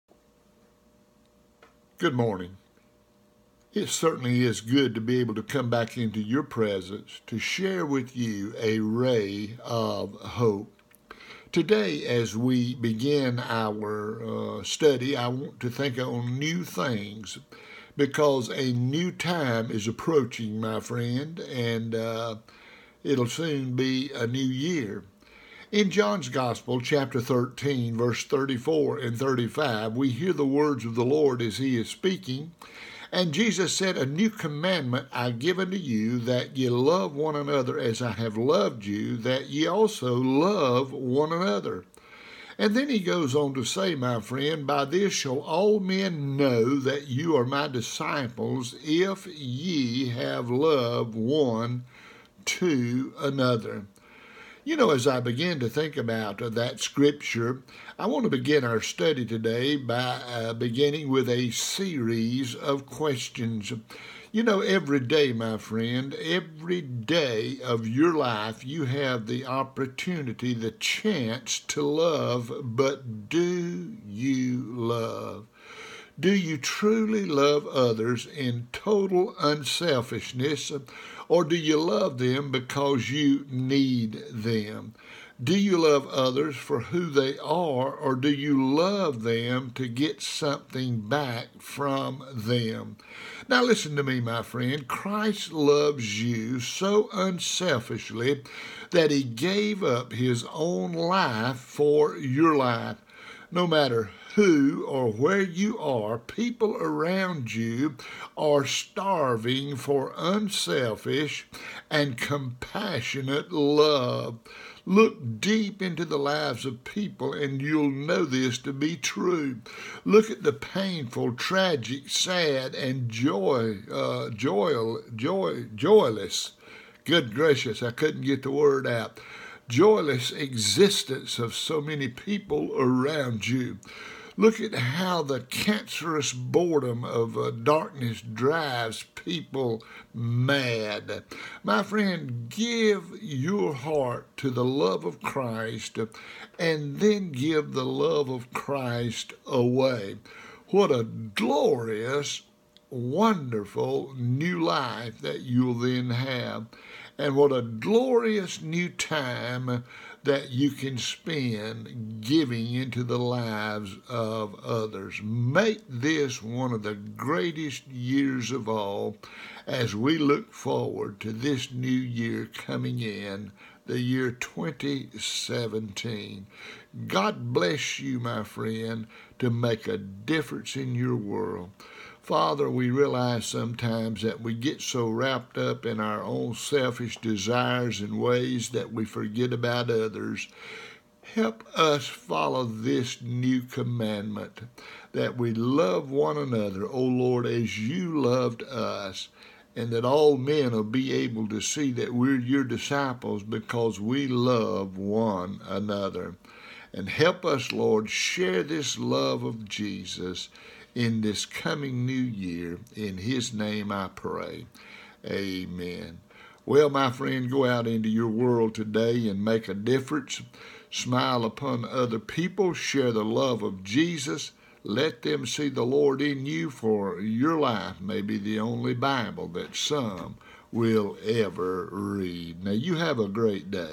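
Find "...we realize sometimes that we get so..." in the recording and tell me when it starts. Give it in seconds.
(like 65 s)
182 s.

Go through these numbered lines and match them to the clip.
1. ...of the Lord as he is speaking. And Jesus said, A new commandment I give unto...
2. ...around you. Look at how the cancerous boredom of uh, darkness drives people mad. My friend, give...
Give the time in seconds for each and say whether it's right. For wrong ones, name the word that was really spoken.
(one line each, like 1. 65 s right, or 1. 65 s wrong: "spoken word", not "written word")
1. 30 s right
2. 132 s right.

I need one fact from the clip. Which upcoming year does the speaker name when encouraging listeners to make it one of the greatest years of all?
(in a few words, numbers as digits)
2017.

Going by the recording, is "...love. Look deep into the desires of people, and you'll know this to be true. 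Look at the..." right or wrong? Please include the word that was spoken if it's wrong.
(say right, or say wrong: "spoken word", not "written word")
wrong: "lives", not "desires".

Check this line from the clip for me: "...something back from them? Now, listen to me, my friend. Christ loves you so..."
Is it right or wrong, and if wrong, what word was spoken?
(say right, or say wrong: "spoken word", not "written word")
right.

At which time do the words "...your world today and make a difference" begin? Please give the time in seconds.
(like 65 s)
218 s.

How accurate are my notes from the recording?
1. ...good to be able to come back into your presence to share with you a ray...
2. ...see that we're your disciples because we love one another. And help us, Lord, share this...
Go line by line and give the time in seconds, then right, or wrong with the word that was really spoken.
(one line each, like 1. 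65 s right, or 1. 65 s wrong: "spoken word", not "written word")
1. 4 s right
2. 201 s right.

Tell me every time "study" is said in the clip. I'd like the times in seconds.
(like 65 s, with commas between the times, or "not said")
14 s, 58 s.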